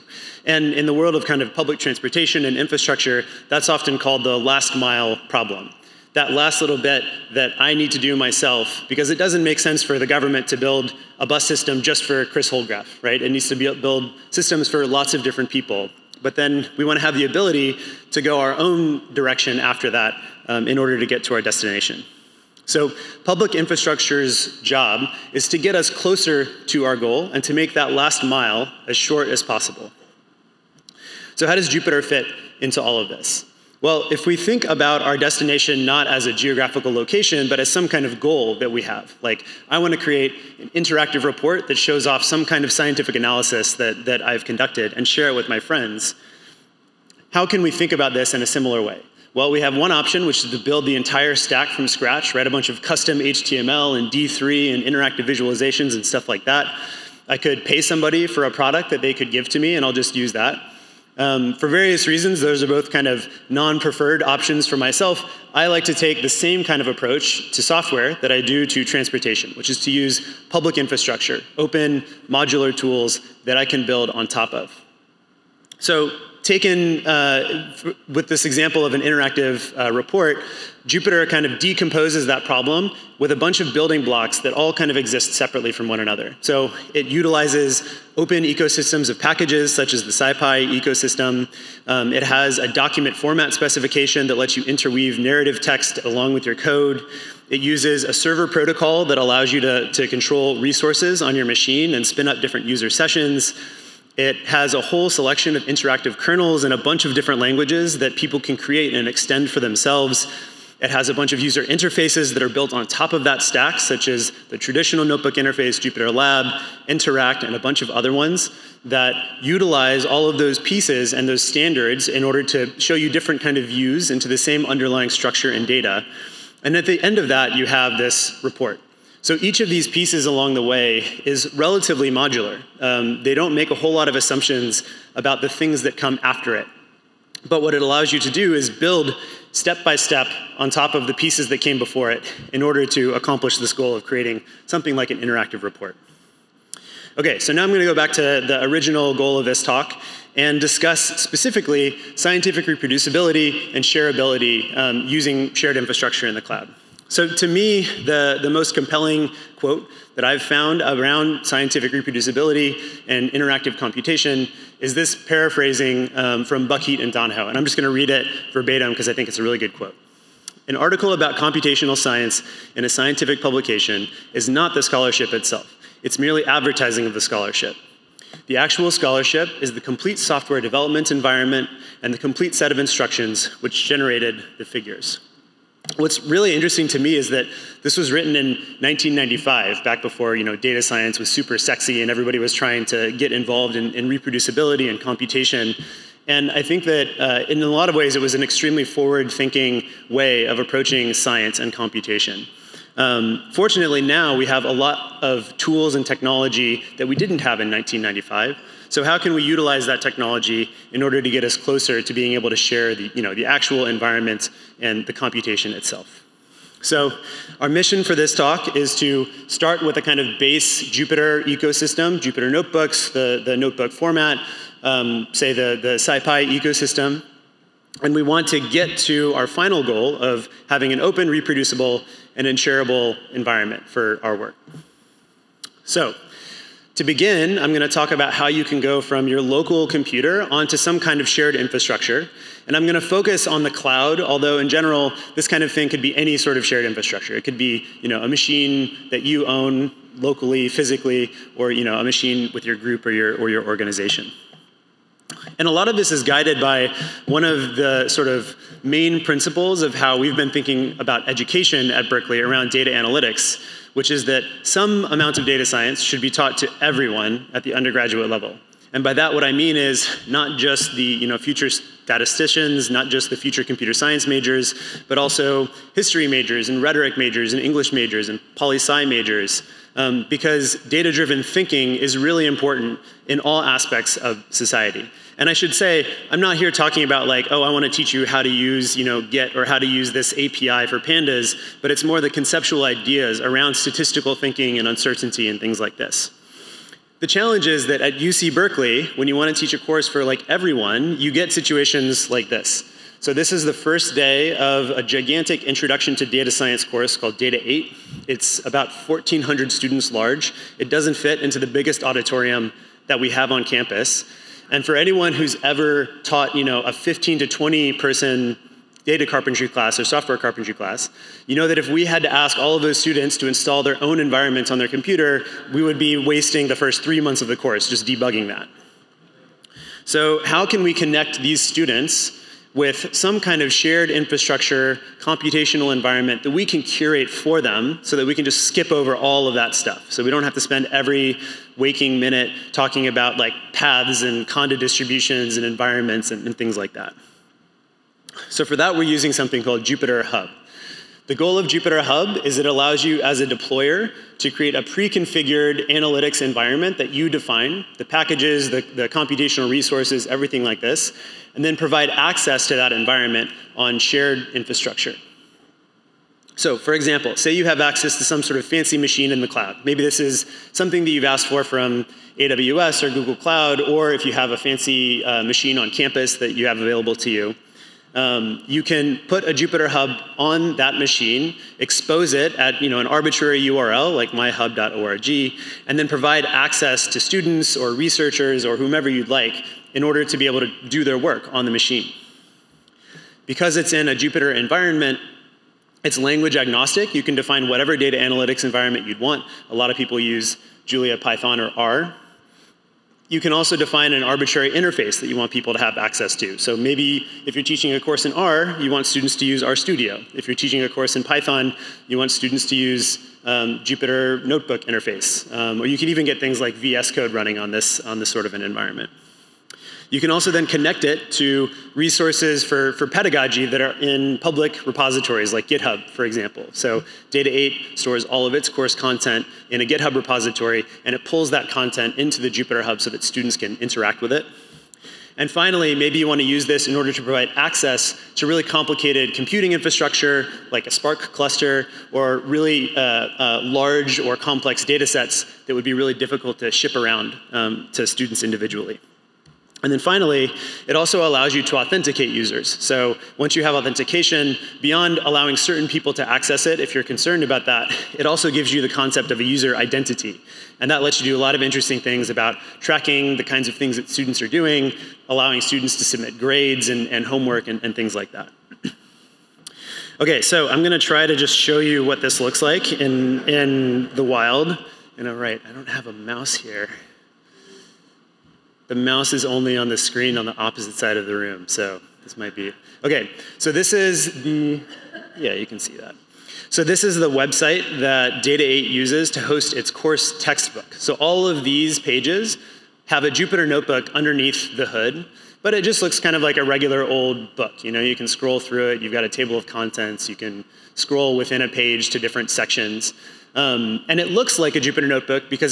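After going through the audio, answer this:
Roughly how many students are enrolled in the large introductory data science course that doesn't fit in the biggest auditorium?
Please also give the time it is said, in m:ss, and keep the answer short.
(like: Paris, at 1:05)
1,400, at 5:08.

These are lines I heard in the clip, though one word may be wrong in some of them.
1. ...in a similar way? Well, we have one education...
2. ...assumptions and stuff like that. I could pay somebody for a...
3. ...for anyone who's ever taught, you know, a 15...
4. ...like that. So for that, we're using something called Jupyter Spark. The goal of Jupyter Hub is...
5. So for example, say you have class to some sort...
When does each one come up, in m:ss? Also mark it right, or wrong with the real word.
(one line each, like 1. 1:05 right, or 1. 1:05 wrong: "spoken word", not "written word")
1. 0:48 wrong: "option", not "education"
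2. 0:55 wrong: "visualizations", not "assumptions"
3. 5:14 right
4. 5:46 wrong: "Hub", not "Spark"
5. 6:06 wrong: "access", not "class".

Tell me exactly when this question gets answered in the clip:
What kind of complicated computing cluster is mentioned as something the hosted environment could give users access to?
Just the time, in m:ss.
7:20.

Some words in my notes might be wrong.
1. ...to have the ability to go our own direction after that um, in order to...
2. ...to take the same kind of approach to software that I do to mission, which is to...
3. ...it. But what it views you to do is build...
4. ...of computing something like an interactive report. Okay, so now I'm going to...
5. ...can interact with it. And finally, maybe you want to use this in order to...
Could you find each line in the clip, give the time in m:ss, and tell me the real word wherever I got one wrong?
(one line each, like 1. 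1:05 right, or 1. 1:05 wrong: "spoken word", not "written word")
1. 0:16 right
2. 1:05 wrong: "transportation", not "mission"
3. 2:16 wrong: "allows", not "views"
4. 2:23 wrong: "creating", not "computing"
5. 7:13 right.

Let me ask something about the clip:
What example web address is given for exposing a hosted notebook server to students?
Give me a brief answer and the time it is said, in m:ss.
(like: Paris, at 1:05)
myhub.org, at 6:24.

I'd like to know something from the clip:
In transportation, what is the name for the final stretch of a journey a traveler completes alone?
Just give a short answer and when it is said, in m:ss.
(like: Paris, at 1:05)
last mile problem, at 0:04.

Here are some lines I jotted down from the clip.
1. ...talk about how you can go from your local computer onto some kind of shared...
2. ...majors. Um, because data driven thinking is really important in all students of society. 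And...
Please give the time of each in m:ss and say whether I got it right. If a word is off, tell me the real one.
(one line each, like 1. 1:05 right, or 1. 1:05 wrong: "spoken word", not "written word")
1. 3:57 right
2. 4:39 wrong: "aspects", not "students".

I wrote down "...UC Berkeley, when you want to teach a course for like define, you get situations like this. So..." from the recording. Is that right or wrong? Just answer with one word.
wrong.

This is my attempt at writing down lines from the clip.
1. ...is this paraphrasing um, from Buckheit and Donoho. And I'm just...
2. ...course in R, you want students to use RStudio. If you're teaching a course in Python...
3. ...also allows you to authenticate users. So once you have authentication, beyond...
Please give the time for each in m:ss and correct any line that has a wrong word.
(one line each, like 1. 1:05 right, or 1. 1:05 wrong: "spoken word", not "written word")
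1. 2:44 right
2. 6:47 right
3. 7:30 right.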